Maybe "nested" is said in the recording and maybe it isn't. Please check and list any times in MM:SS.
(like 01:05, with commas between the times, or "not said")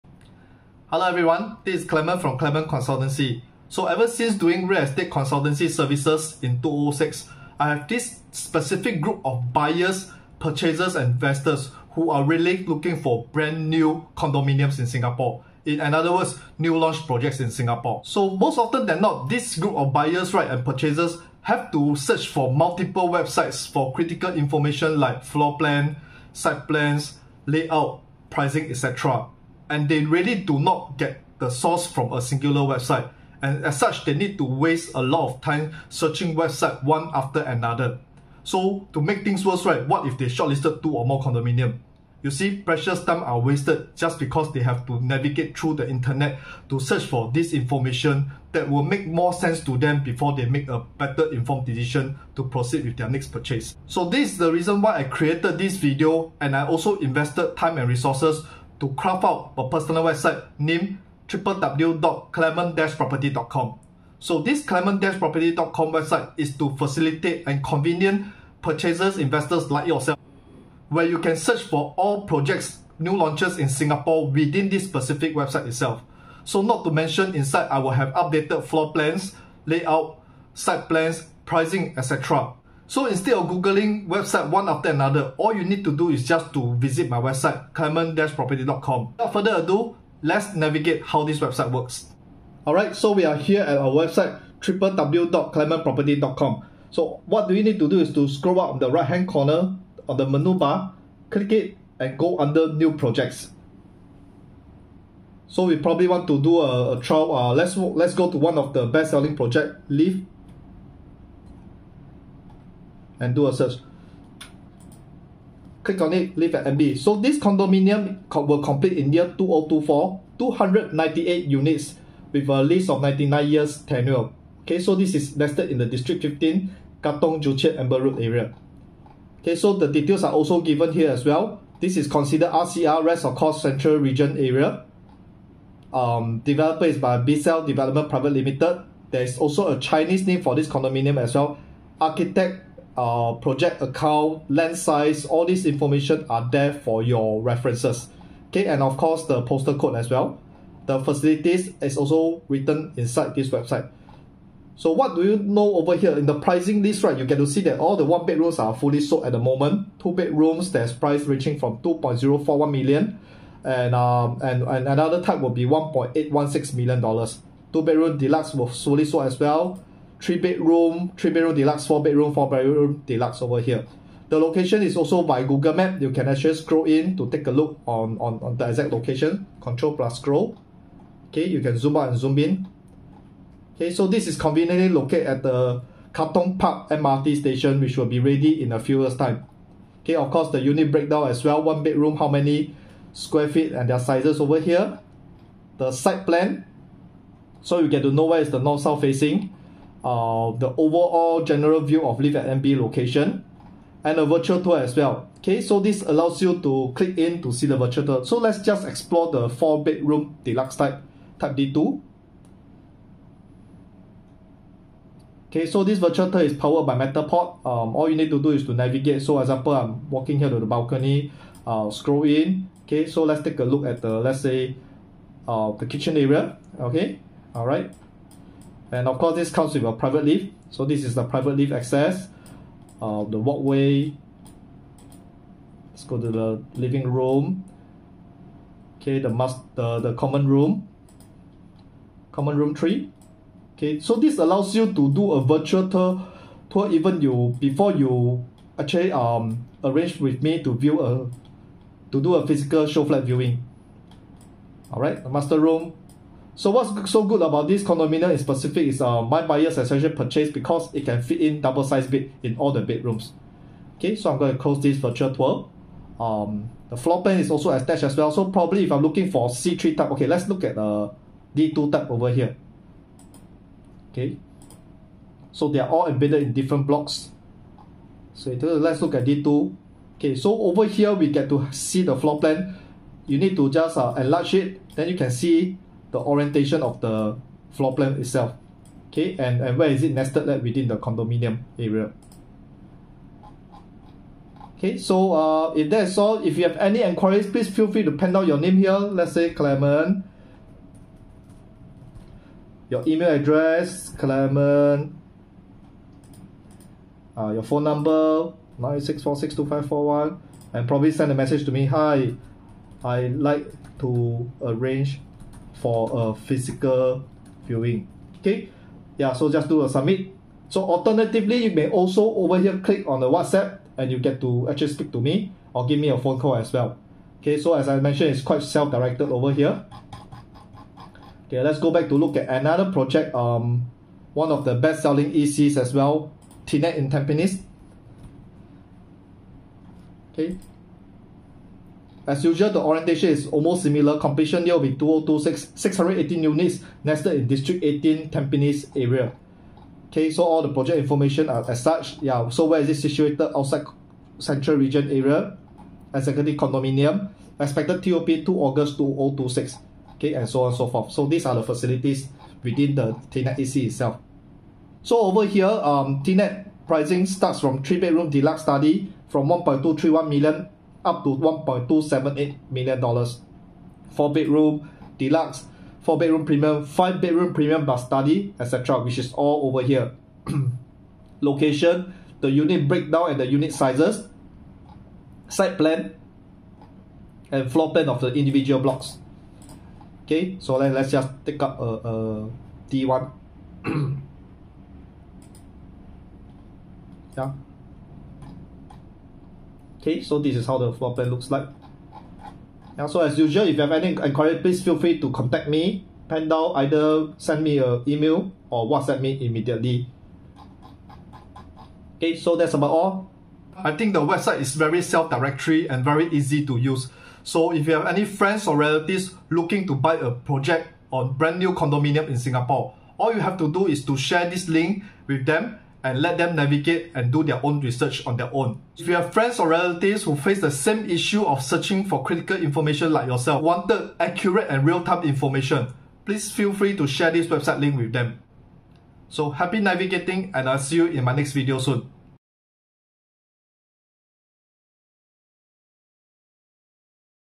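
04:50, 05:47.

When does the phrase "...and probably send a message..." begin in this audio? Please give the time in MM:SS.
05:10.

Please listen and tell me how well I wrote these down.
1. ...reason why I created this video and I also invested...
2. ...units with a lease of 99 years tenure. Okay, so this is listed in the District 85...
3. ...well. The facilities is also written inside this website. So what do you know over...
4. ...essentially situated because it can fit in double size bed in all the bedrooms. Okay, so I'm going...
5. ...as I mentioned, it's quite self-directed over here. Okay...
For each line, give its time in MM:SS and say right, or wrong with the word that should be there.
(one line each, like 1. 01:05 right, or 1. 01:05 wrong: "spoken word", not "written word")
1. 00:54 right
2. 02:01 wrong: "15", not "85"
3. 02:30 right
4. 04:19 wrong: "purchased", not "situated"
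5. 05:27 right.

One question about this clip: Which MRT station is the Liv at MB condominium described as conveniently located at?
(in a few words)
Katong Park.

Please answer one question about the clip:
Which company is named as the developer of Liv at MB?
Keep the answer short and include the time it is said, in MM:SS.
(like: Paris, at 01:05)
Cell Development Private Limited, at 02:17.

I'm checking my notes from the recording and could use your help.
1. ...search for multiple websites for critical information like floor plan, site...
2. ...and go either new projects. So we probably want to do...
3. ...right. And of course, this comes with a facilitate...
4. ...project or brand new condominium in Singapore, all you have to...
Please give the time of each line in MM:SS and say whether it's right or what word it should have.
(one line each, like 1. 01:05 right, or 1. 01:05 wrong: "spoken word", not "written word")
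1. 00:21 right
2. 01:41 wrong: "under", not "either"
3. 03:47 wrong: "private", not "facilitate"
4. 07:00 right.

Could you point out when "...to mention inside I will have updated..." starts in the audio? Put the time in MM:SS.
01:16.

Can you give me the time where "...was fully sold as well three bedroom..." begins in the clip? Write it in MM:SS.
02:48.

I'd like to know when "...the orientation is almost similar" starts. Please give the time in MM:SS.
05:42.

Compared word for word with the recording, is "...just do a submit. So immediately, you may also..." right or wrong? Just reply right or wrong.
wrong.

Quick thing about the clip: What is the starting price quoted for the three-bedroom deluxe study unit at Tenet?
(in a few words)
$1.231 million.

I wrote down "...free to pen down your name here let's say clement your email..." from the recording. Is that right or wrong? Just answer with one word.
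right.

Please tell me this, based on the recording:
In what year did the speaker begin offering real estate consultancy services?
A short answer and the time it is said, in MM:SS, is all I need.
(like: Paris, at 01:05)
2006, at 00:06.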